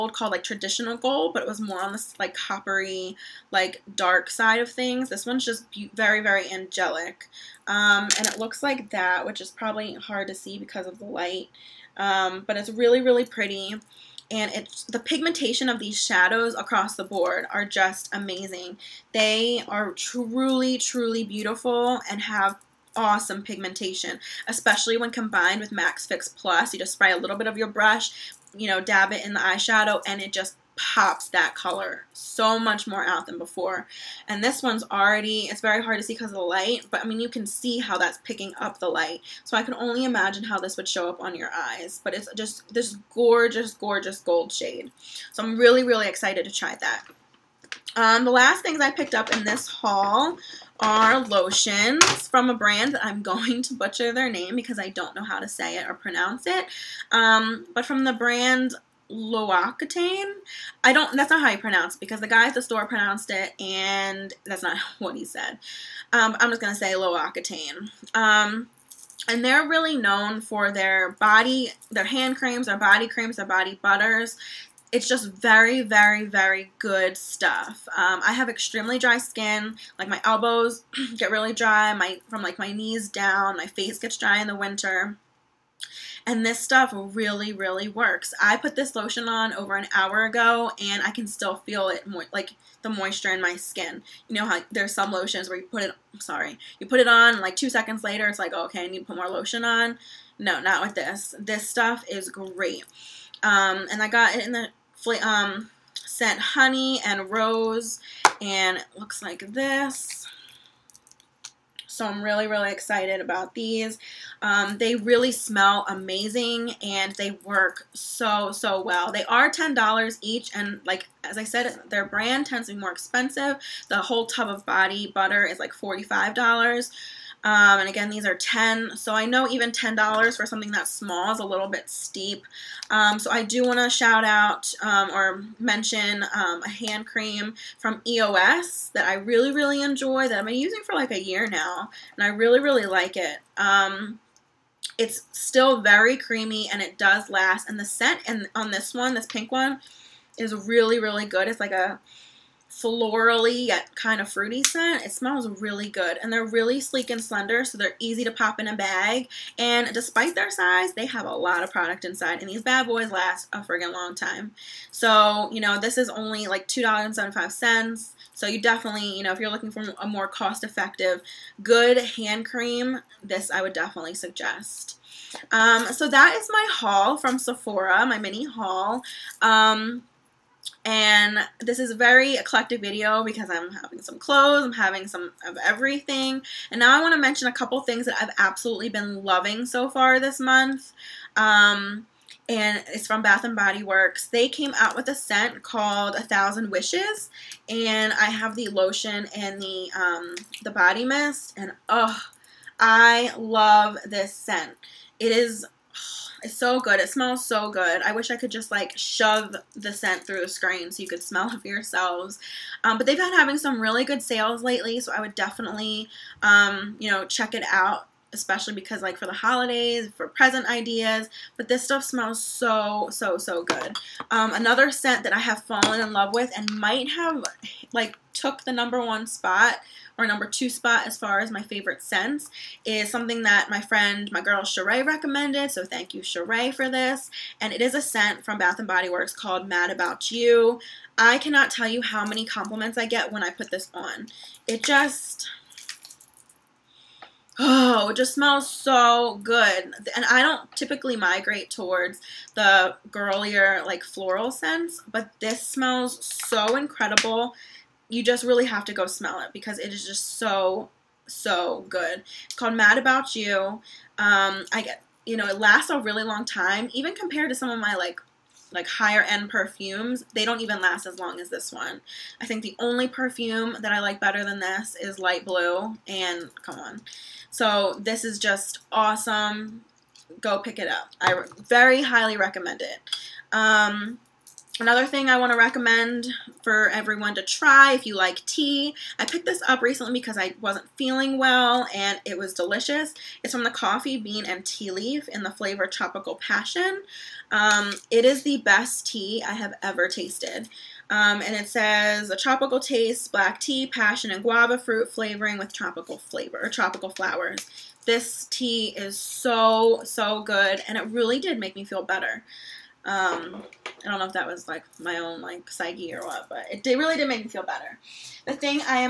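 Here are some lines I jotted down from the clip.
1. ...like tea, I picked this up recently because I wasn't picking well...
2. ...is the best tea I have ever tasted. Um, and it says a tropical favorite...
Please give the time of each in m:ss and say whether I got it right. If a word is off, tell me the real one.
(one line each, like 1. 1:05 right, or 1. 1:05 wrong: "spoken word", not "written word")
1. 4:48 wrong: "feeling", not "picking"
2. 4:58 wrong: "taste", not "favorite".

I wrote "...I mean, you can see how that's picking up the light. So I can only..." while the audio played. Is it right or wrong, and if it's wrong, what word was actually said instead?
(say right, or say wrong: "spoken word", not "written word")
right.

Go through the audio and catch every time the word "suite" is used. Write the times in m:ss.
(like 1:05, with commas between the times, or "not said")
not said.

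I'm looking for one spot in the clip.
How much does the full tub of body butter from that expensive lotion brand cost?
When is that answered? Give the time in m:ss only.
2:05.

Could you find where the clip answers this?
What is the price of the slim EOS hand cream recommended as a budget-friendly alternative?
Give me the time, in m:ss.
2:46.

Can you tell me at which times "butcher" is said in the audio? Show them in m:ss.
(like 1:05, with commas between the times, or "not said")
0:53.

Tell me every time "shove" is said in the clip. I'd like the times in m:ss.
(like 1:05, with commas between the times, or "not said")
3:28.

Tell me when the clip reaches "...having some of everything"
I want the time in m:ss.
3:04.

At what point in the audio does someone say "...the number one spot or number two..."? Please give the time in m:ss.
3:48.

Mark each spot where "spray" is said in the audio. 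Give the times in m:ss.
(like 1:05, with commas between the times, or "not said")
0:26.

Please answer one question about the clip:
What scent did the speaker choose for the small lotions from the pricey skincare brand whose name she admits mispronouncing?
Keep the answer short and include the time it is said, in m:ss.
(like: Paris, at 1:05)
Honey and rose, at 1:46.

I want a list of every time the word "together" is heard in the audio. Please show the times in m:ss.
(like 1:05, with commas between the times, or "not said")
not said.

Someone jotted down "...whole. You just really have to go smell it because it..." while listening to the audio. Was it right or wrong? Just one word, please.
wrong.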